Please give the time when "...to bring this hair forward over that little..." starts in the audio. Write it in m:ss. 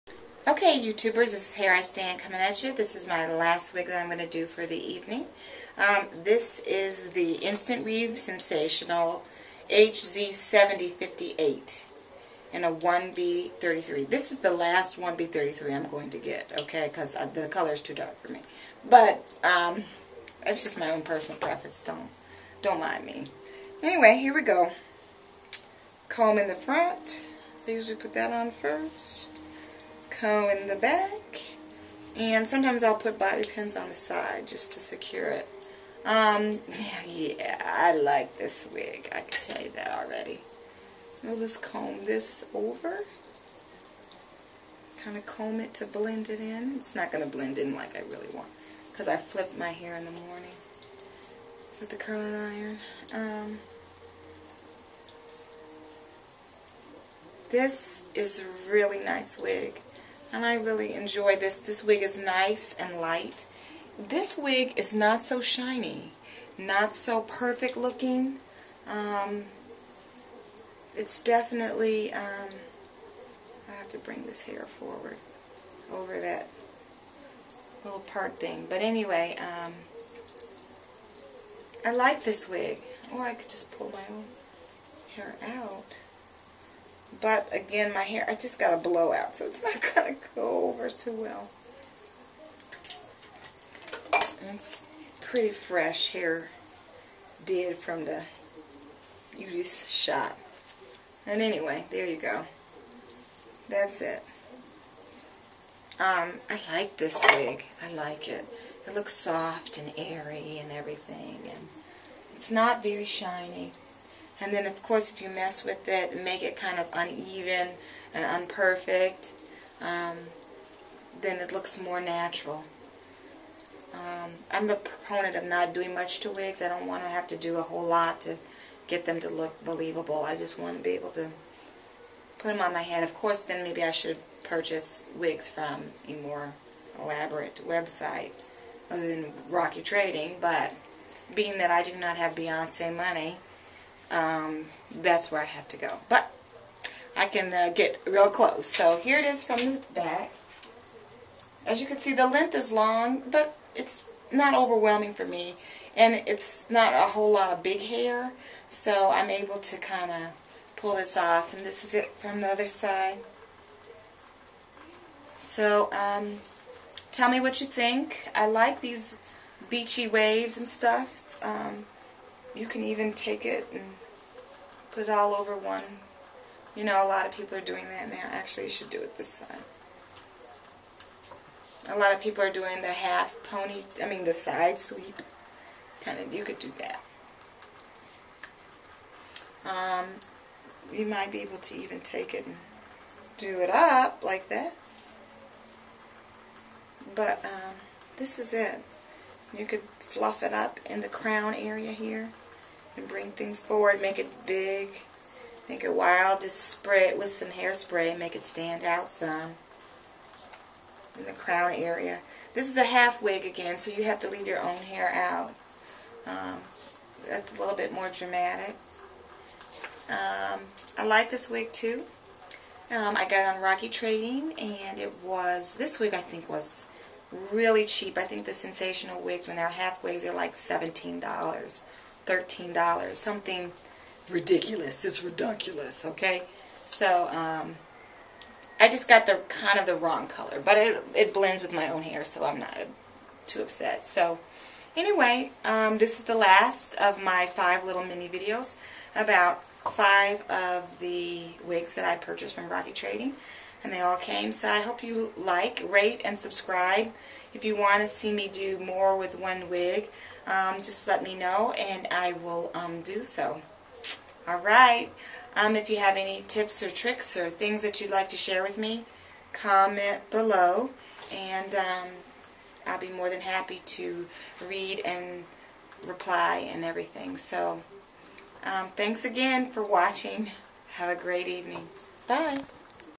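1:13.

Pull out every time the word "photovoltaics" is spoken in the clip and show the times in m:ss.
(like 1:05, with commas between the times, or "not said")
not said.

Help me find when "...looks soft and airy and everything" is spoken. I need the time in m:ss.
1:48.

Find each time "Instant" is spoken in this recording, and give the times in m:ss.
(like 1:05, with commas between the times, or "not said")
0:07.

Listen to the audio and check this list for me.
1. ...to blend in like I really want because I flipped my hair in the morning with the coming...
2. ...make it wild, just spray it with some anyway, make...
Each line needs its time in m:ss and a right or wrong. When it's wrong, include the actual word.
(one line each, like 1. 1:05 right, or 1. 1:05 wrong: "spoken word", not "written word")
1. 0:47 wrong: "curling", not "coming"
2. 3:25 wrong: "hairspray", not "anyway".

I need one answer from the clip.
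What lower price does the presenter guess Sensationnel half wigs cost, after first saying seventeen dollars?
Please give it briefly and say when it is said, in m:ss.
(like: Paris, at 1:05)
$13, at 3:52.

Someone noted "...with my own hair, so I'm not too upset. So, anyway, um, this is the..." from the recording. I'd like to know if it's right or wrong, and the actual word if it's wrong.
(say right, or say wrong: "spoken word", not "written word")
right.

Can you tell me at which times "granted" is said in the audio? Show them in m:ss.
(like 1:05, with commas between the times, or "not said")
not said.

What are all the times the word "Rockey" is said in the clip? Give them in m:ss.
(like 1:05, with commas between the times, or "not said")
2:19, 3:43, 4:12.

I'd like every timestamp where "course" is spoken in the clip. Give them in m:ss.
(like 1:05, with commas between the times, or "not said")
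1:54, 2:13.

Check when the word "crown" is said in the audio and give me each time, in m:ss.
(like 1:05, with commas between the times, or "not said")
3:21, 3:31.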